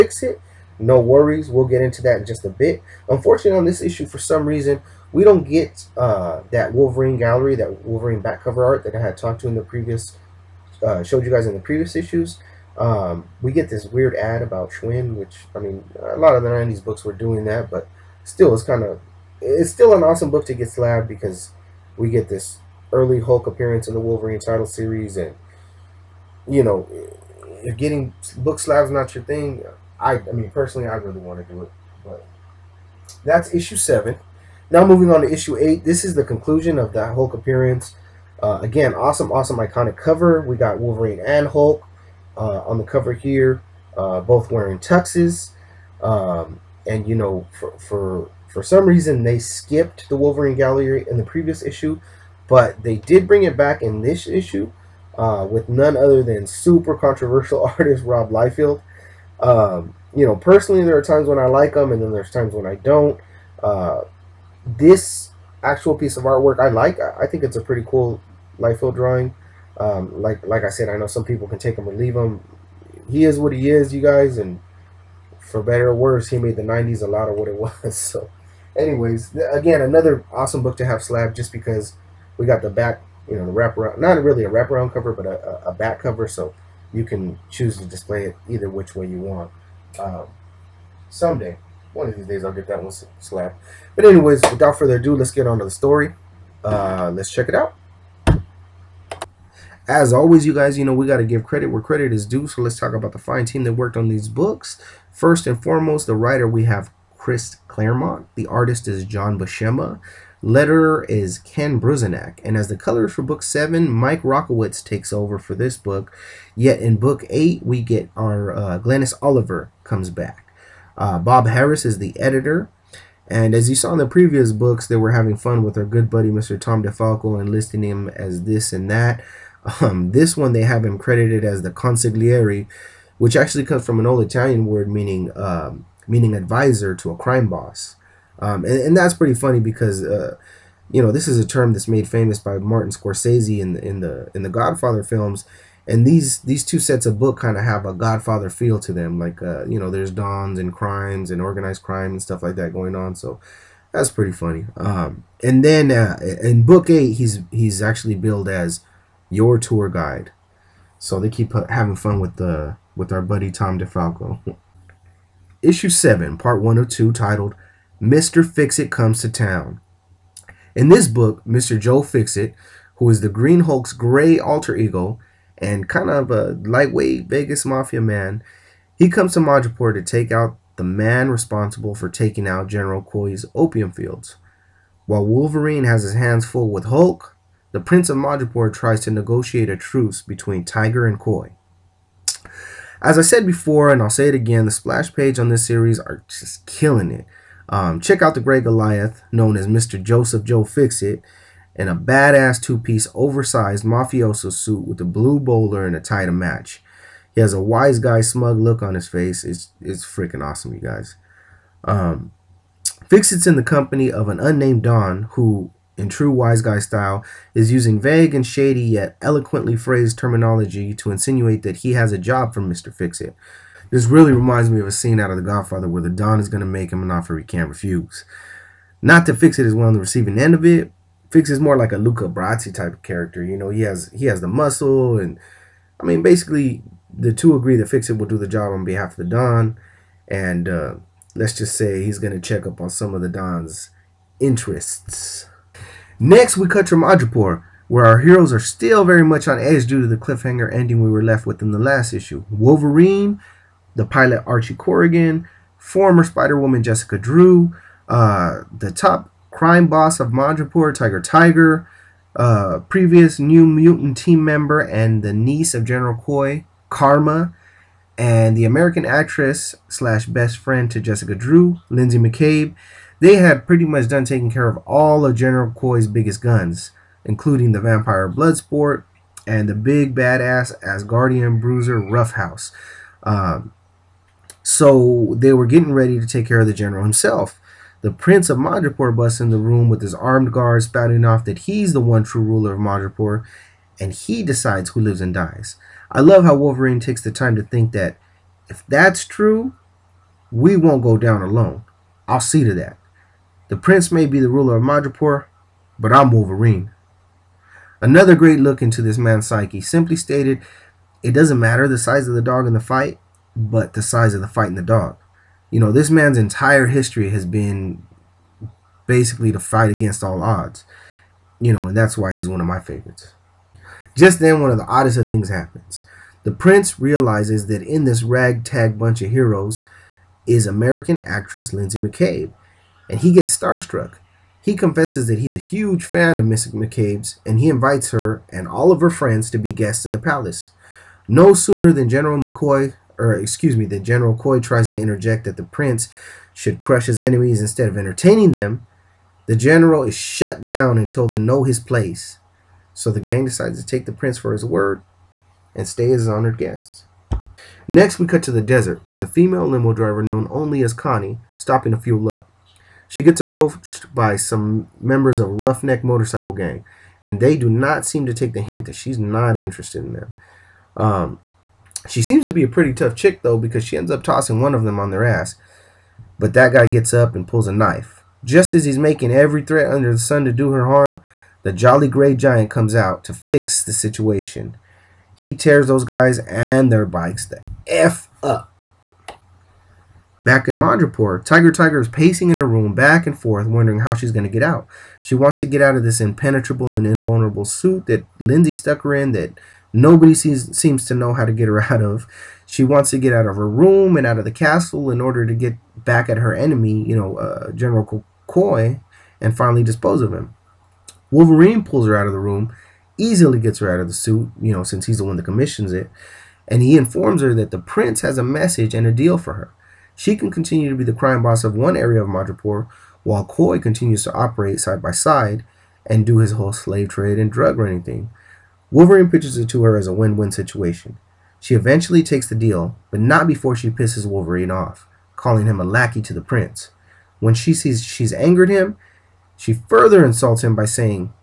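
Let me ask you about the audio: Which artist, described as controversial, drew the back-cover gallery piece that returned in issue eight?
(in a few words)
Rob Liefeld.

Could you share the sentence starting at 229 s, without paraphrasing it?
Not that Fixit is one on the receiving end of it.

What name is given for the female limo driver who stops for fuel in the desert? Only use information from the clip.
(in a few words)
Connie.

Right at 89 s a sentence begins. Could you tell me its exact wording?
Um, someday, one of these days, I'll get that one slab.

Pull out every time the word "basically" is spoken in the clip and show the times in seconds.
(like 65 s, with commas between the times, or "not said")
236 s, 319 s.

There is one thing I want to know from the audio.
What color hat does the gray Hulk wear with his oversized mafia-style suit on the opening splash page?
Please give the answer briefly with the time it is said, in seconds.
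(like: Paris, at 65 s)
blue bowler, at 205 s.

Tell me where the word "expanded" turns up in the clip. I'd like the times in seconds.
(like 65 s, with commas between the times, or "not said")
not said.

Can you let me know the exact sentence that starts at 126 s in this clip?
Tom DeFalco and listing him as this and that.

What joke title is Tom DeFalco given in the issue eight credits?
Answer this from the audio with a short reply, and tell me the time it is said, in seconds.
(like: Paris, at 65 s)
tour guide, at 159 s.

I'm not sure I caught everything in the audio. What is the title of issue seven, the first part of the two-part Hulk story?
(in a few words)
Mr. Fixit Comes to Town.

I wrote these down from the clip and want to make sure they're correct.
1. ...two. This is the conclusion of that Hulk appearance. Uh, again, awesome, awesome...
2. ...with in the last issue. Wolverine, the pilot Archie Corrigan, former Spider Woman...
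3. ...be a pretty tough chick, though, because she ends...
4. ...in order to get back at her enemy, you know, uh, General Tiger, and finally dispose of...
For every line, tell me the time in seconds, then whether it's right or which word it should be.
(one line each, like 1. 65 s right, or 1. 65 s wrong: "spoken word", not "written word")
1. 35 s wrong: "eight", not "two"
2. 251 s right
3. 372 s right
4. 405 s wrong: "Coy", not "Tiger".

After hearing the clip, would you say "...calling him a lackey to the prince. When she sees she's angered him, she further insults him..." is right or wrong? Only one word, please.
right.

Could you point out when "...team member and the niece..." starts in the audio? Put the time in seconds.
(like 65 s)
264 s.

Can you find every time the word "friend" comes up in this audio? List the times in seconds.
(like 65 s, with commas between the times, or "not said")
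270 s, 339 s.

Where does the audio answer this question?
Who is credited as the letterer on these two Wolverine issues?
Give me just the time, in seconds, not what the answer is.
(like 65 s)
111 s.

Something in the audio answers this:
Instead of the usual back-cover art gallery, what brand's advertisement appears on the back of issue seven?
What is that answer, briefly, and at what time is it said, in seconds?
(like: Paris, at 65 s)
Schwinn, at 14 s.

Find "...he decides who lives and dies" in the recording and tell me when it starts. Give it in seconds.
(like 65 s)
294 s.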